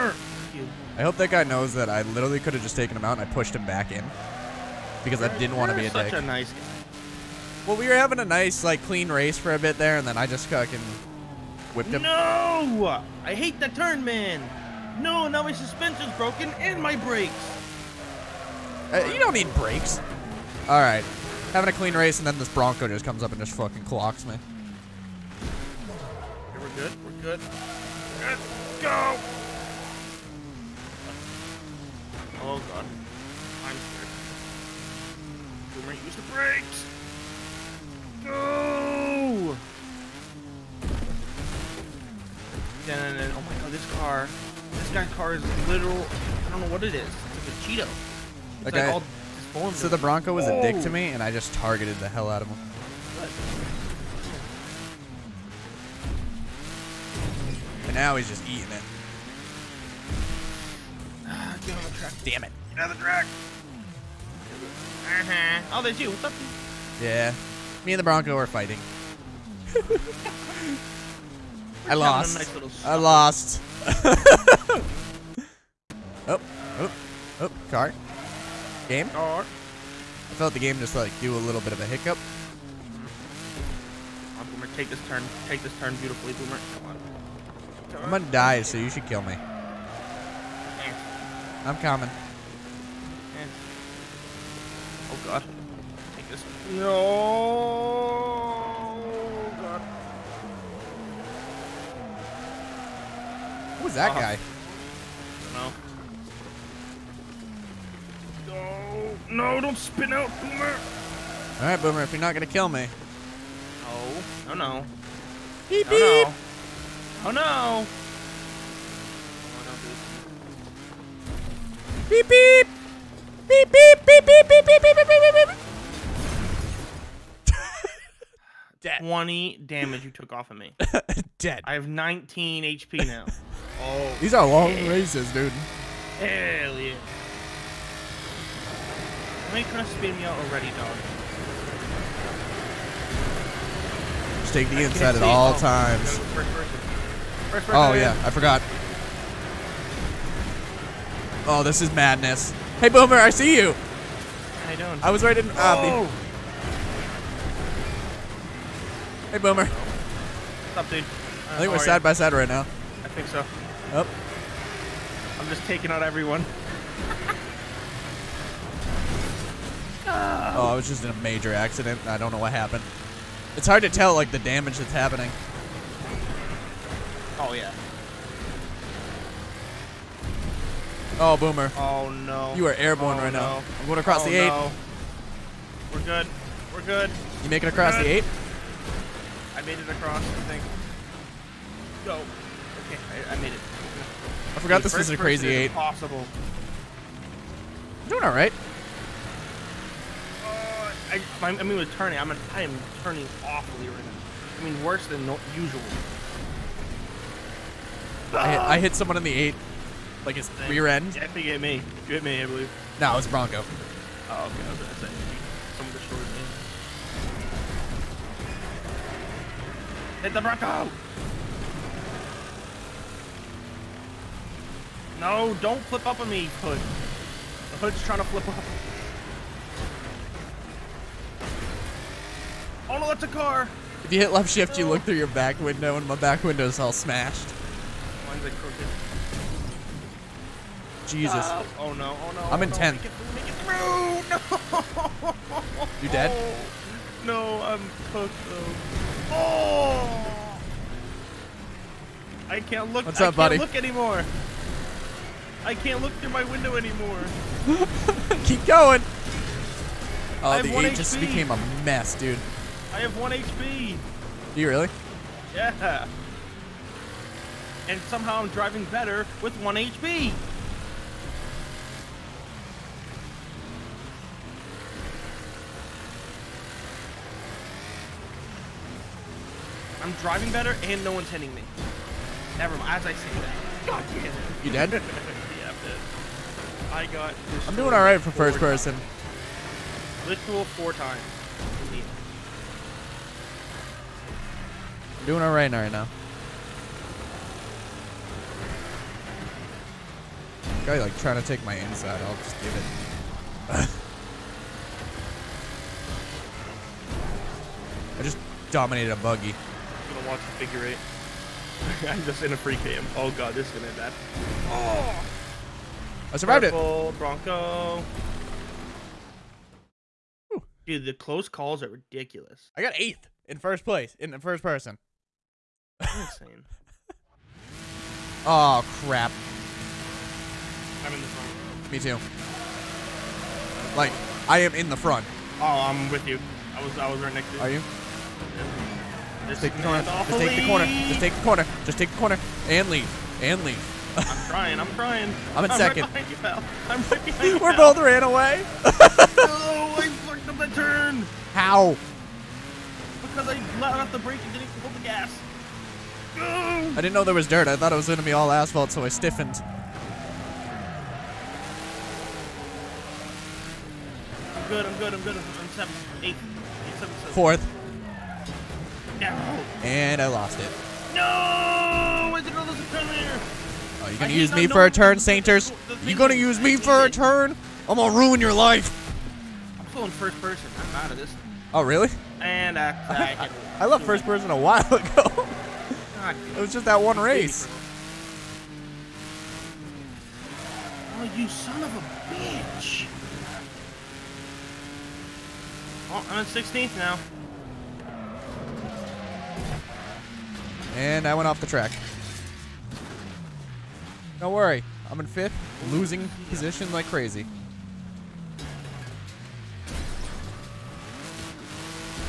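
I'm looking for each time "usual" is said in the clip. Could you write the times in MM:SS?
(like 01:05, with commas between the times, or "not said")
03:25.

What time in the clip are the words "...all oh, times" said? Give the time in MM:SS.
02:25.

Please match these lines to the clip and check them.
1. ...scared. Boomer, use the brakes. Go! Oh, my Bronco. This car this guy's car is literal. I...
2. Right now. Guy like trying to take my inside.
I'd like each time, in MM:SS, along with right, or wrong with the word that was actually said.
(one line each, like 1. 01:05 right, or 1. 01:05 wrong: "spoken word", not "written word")
1. 00:33 wrong: "God", not "Bronco"
2. 04:55 right.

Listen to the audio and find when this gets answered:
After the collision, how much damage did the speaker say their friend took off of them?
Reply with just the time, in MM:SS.
02:08.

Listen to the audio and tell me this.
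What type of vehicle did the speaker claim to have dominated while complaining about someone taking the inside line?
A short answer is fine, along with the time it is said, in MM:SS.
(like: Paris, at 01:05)
buggy, at 05:09.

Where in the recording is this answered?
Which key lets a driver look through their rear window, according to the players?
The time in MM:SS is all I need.
03:54.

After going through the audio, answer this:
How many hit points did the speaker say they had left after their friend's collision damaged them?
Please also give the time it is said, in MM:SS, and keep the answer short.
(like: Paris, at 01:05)
19, at 02:11.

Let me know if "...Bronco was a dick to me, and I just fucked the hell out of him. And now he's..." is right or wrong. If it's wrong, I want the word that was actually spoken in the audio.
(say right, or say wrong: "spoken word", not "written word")
wrong: "targeted", not "fucked".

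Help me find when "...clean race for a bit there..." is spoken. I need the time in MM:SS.
00:08.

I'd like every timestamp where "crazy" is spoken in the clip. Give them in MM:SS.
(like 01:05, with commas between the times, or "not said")
03:15, 06:47.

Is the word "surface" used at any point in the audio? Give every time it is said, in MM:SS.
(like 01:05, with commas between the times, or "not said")
not said.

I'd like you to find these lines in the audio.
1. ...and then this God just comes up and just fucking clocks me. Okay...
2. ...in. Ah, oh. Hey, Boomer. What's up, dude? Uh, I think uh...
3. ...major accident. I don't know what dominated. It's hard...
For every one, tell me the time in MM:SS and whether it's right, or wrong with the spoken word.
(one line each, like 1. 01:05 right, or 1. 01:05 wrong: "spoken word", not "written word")
1. 00:22 wrong: "Bronco", not "God"
2. 02:35 right
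3. 02:51 wrong: "happened", not "dominated".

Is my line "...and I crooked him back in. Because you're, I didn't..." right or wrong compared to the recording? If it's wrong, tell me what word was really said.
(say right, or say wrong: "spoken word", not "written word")
wrong: "pushed", not "crooked".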